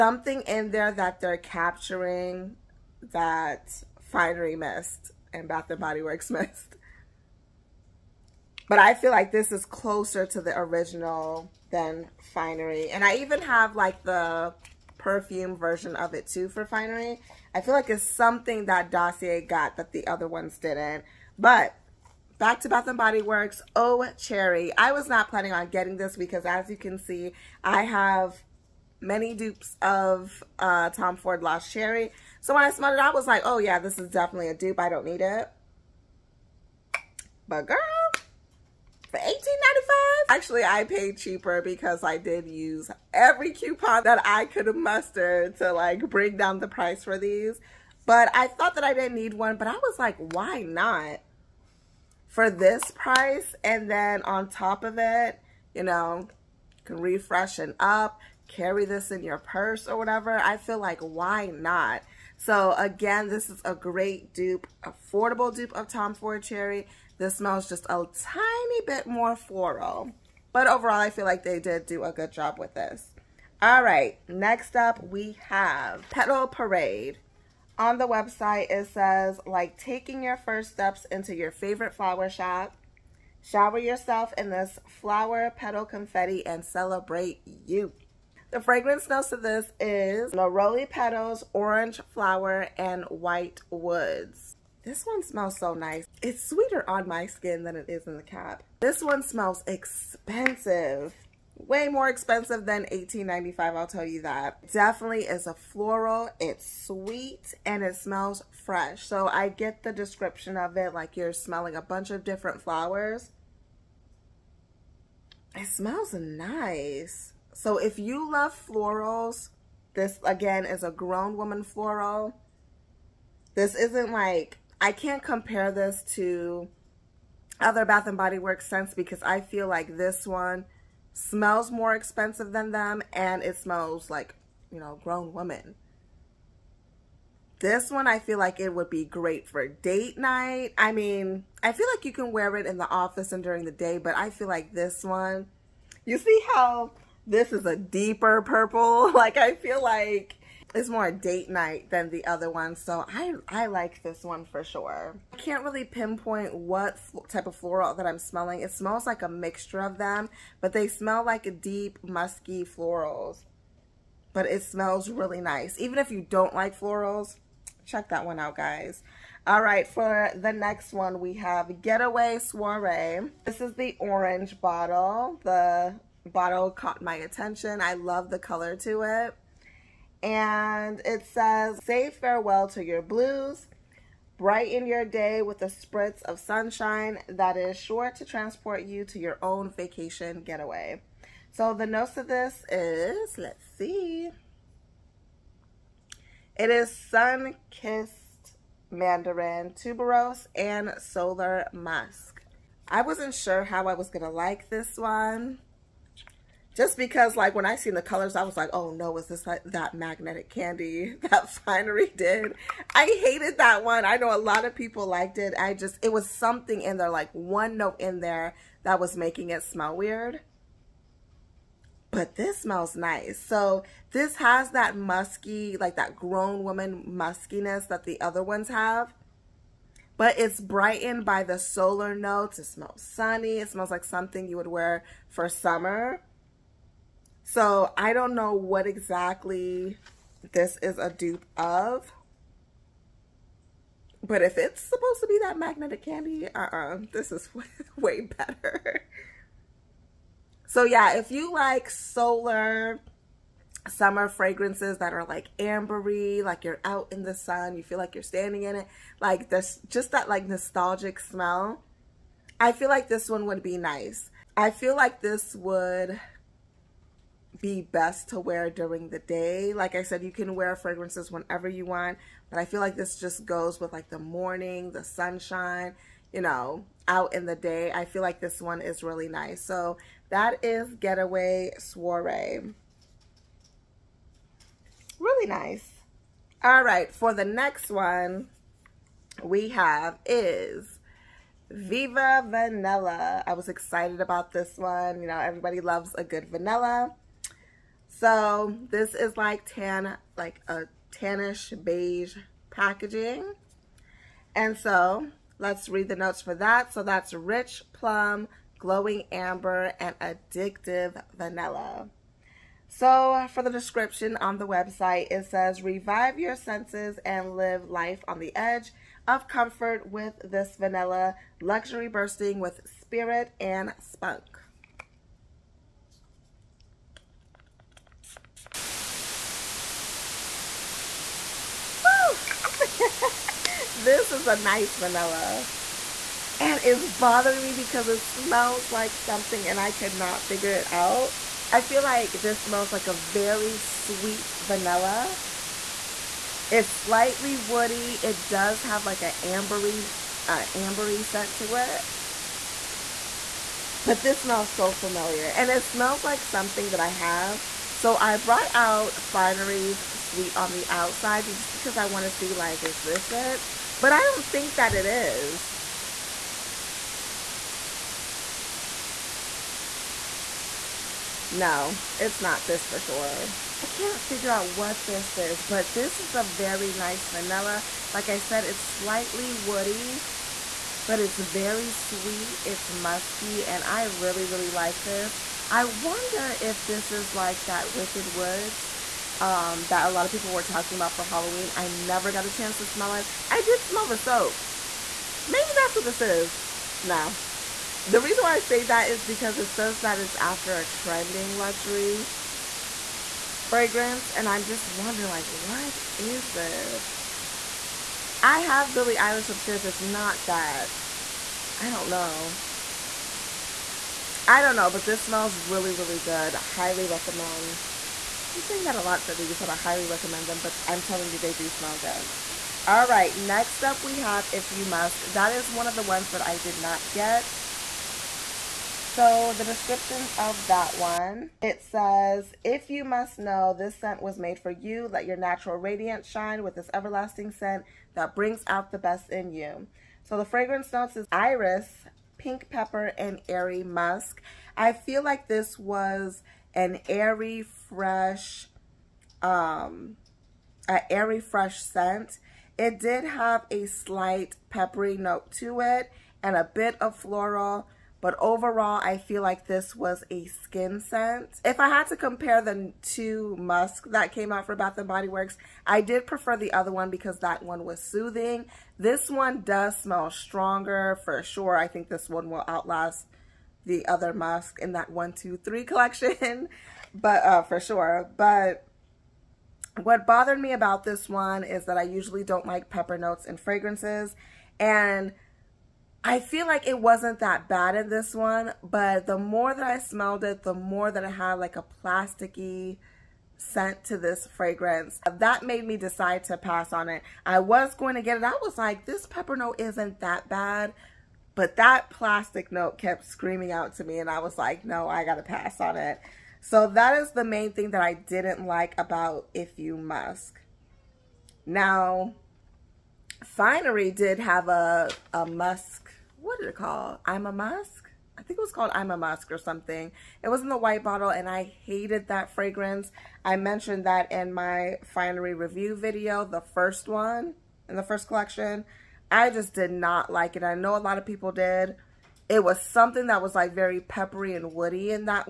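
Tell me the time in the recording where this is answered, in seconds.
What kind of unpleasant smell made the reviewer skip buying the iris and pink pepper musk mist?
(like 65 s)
492 s.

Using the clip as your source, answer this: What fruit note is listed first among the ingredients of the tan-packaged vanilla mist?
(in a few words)
Rich plum.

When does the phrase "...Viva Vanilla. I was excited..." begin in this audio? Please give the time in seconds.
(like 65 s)
291 s.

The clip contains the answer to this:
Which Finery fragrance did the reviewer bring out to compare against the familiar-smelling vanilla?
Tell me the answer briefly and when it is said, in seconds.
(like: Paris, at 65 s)
Sweet on the Outside, at 360 s.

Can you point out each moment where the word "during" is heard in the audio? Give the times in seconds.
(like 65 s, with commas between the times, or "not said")
143 s, 268 s.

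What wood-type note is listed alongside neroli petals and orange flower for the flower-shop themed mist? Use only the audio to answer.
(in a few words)
White Woods.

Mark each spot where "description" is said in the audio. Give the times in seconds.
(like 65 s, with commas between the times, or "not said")
109 s, 313 s, 429 s.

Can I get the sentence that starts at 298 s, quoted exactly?
So this is like tan, like a tannish beige packaging.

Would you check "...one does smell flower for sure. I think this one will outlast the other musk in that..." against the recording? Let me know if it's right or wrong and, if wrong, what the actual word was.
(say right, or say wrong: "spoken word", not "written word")
wrong: "stronger", not "flower".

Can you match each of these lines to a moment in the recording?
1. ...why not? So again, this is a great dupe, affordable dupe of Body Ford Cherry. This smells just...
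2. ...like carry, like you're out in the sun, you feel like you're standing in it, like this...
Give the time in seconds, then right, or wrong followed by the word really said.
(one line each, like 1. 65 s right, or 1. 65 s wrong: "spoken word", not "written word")
1. 61 s wrong: "Tom", not "Body"
2. 255 s wrong: "ambery", not "carry".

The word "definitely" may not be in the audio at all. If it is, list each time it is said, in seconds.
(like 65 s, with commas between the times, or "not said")
34 s, 104 s.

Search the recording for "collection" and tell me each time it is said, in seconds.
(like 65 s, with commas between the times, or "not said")
475 s, 528 s.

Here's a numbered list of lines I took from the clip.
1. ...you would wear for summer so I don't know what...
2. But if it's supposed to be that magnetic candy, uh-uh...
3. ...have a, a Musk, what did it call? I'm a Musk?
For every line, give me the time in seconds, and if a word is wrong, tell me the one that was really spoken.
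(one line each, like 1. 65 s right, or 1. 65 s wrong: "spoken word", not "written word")
1. 234 s right
2. 244 s right
3. 514 s right.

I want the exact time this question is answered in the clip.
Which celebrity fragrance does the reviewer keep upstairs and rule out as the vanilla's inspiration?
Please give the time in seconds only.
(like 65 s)
408 s.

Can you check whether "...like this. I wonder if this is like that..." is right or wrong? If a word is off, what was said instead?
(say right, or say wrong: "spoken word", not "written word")
right.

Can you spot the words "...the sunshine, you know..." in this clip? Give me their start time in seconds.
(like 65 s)
274 s.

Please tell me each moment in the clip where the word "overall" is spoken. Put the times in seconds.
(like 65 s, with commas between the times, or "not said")
70 s, 458 s.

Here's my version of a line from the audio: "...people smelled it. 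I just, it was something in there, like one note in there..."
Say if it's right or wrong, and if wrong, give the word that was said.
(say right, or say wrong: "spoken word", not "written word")
wrong: "liked", not "smelled".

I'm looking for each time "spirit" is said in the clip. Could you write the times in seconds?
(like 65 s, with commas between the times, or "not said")
323 s.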